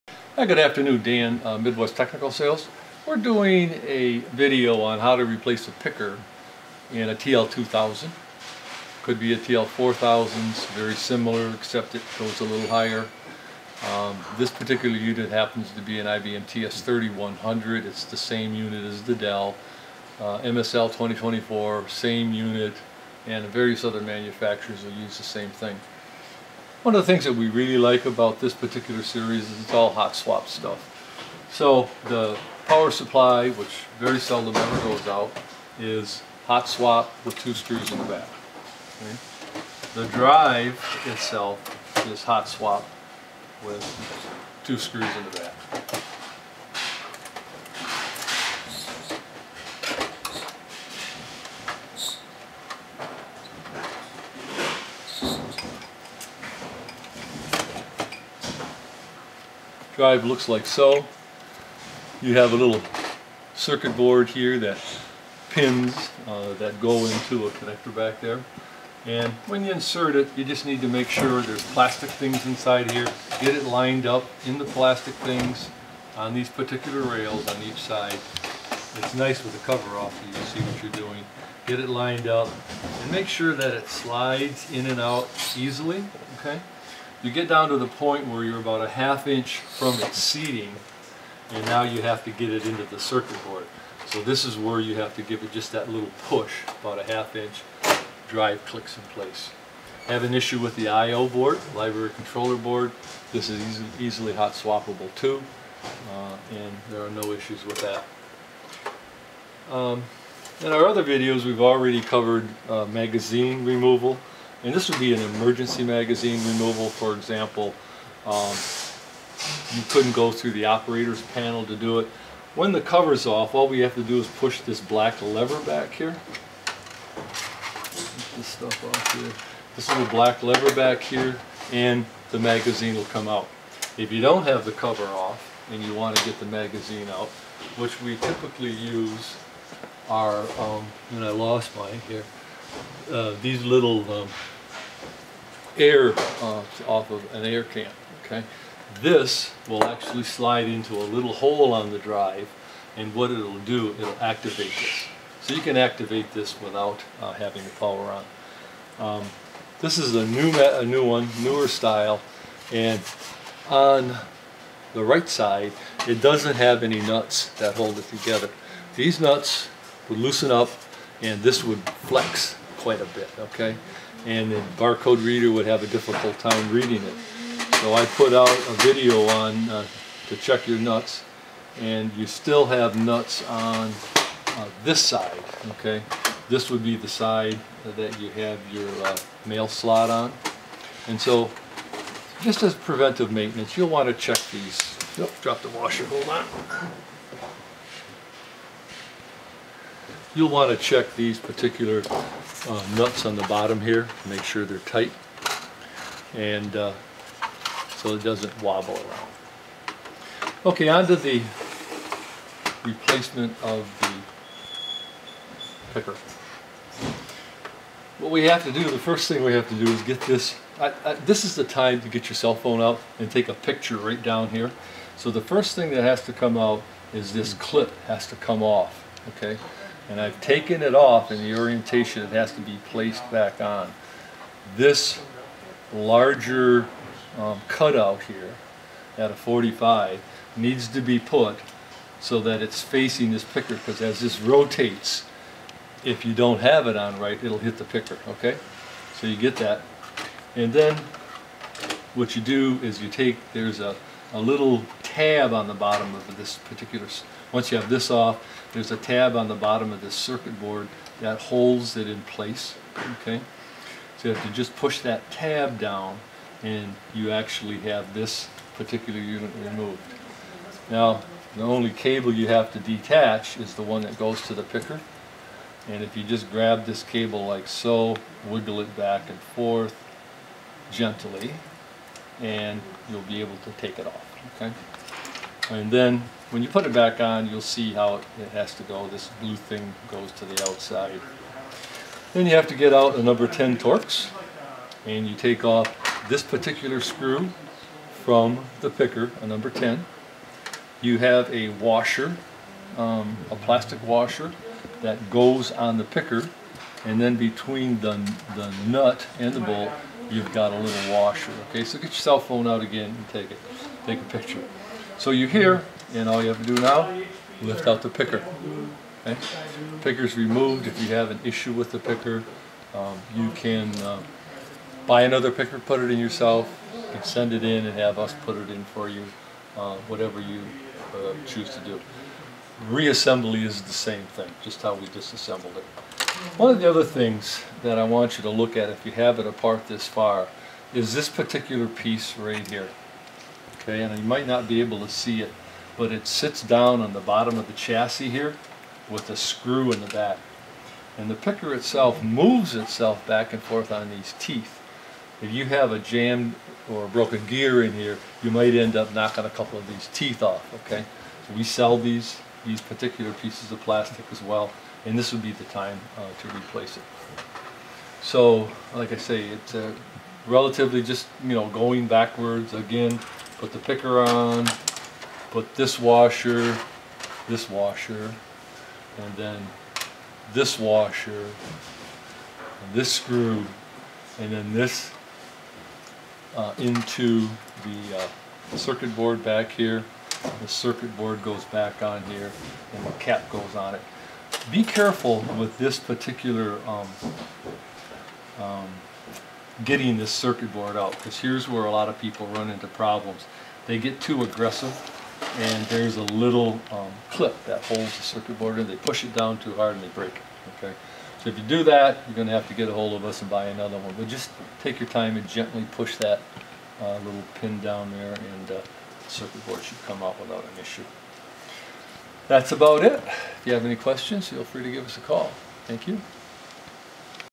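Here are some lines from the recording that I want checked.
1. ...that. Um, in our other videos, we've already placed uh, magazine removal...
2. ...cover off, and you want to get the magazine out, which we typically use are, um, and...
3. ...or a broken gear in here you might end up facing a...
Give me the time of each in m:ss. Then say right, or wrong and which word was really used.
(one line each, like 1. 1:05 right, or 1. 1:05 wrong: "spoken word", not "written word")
1. 1:47 wrong: "covered", not "placed"
2. 2:14 right
3. 5:56 wrong: "knocking", not "facing".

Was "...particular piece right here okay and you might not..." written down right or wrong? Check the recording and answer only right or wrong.
right.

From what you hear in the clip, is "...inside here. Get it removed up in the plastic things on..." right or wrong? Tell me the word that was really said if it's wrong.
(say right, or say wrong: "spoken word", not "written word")
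wrong: "lined", not "removed".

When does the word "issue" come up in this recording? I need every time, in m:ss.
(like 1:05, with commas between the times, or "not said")
1:40, 1:47, 5:21, 7:00.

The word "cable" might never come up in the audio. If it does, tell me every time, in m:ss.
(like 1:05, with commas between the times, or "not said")
4:31, 4:37.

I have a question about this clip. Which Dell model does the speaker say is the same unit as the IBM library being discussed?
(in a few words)
MSL 2024.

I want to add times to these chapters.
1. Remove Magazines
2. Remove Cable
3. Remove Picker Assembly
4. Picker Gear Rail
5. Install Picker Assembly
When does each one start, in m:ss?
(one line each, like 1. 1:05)
1. 2:00
2. 3:38
3. 4:51
4. 5:36
5. 6:10.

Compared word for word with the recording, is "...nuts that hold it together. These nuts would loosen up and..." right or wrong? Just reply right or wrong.
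right.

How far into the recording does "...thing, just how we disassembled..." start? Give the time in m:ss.
5:34.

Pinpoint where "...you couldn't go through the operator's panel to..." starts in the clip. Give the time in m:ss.
1:59.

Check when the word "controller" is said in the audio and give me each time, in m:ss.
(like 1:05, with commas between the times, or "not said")
1:42.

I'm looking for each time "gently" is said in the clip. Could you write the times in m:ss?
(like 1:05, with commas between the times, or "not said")
4:40, 6:55.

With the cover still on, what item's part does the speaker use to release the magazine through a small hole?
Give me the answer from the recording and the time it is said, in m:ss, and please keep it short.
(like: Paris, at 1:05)
An air can, at 2:27.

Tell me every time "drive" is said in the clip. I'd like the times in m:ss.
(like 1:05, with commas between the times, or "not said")
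0:40, 1:38, 2:31.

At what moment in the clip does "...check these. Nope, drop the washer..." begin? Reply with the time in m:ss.
3:14.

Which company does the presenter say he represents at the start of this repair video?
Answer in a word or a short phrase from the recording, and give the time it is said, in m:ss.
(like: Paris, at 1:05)
Midwest Technical Sales, at 0:01.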